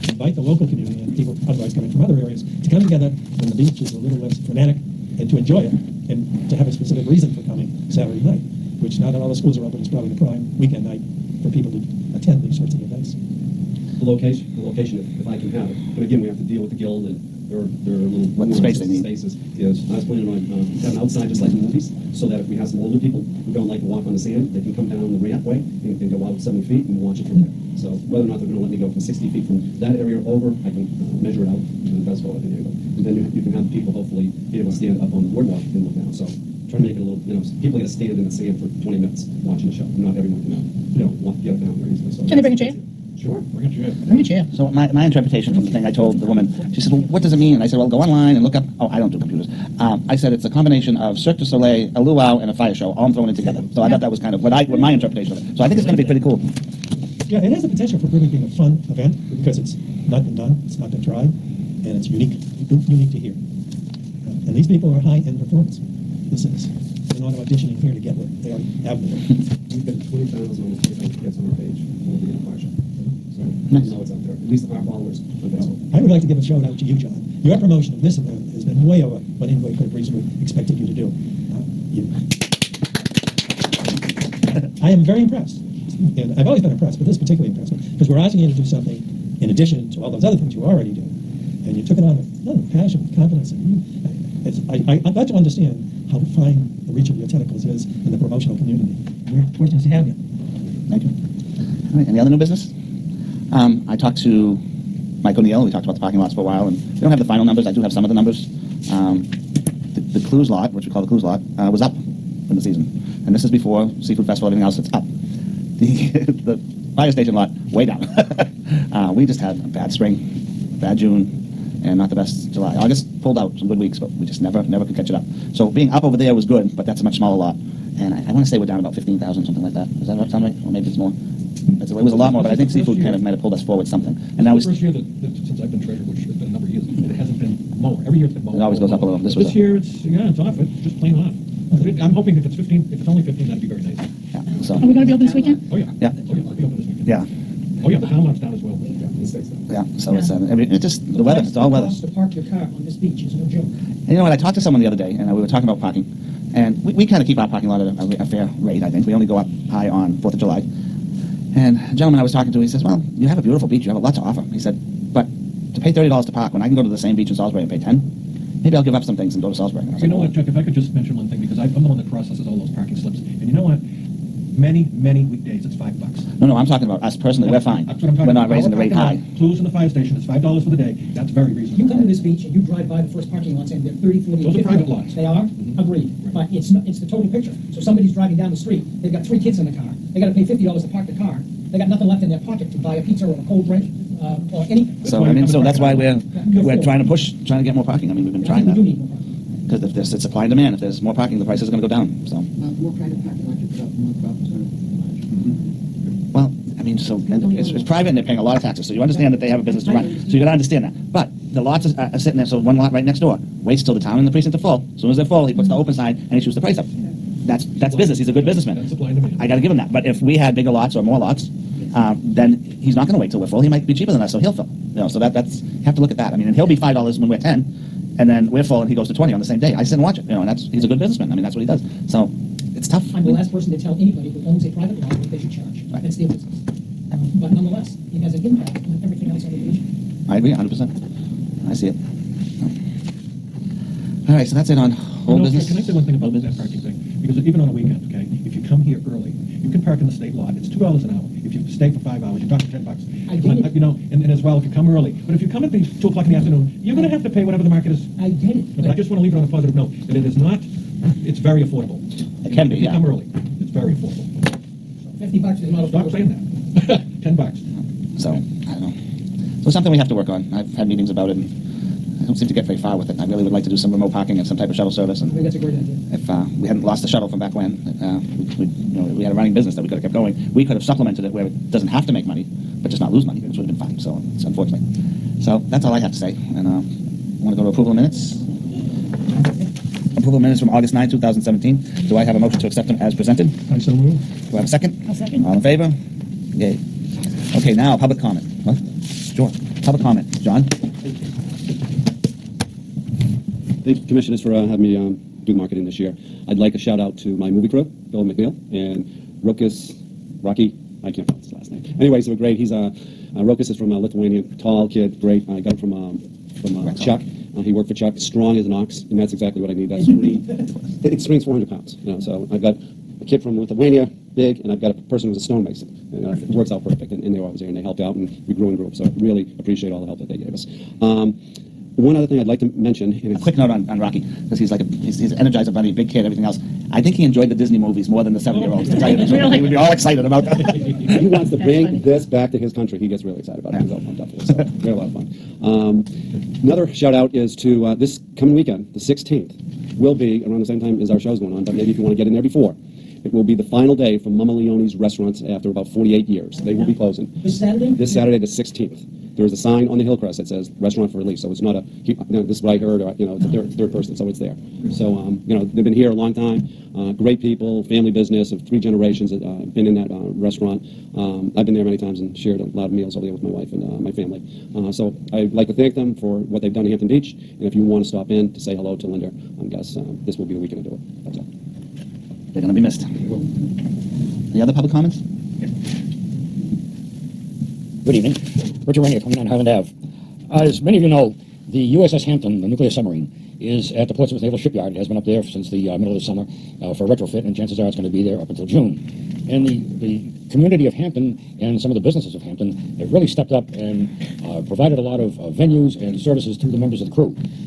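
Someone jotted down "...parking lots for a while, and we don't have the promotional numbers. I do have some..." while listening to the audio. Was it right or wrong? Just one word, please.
wrong.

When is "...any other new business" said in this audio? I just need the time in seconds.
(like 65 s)
102 s.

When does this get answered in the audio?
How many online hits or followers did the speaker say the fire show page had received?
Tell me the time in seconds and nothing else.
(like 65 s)
70 s.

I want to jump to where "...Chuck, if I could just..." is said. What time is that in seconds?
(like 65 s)
170 s.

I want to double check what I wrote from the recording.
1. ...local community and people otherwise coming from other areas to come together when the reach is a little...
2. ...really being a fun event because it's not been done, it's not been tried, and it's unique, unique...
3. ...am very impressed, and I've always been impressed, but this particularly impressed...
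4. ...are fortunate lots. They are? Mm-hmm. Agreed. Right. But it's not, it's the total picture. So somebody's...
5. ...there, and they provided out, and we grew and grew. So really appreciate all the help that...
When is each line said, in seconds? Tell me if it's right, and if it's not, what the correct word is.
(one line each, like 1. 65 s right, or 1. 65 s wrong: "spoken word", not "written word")
1. 0 s wrong: "beach", not "reach"
2. 58 s right
3. 84 s right
4. 184 s wrong: "private", not "fortunate"
5. 327 s wrong: "helped", not "provided".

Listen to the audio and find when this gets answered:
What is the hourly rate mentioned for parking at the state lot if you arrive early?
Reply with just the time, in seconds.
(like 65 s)
250 s.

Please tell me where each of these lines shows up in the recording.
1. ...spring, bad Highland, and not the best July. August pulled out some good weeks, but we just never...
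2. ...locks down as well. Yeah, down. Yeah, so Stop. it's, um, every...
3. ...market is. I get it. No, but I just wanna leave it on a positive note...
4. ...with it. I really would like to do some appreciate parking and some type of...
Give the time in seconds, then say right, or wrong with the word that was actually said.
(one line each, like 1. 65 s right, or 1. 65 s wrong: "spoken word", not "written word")
1. 119 s wrong: "June", not "Highland"
2. 148 s wrong: "Yeah", not "Stop"
3. 257 s right
4. 272 s wrong: "remote", not "appreciate".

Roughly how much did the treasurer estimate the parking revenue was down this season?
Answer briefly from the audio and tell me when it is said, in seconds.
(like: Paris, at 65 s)
about 15,000, at 128 s.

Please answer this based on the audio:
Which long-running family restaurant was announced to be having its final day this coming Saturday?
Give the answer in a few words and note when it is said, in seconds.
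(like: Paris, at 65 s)
Mama Leone's, at 354 s.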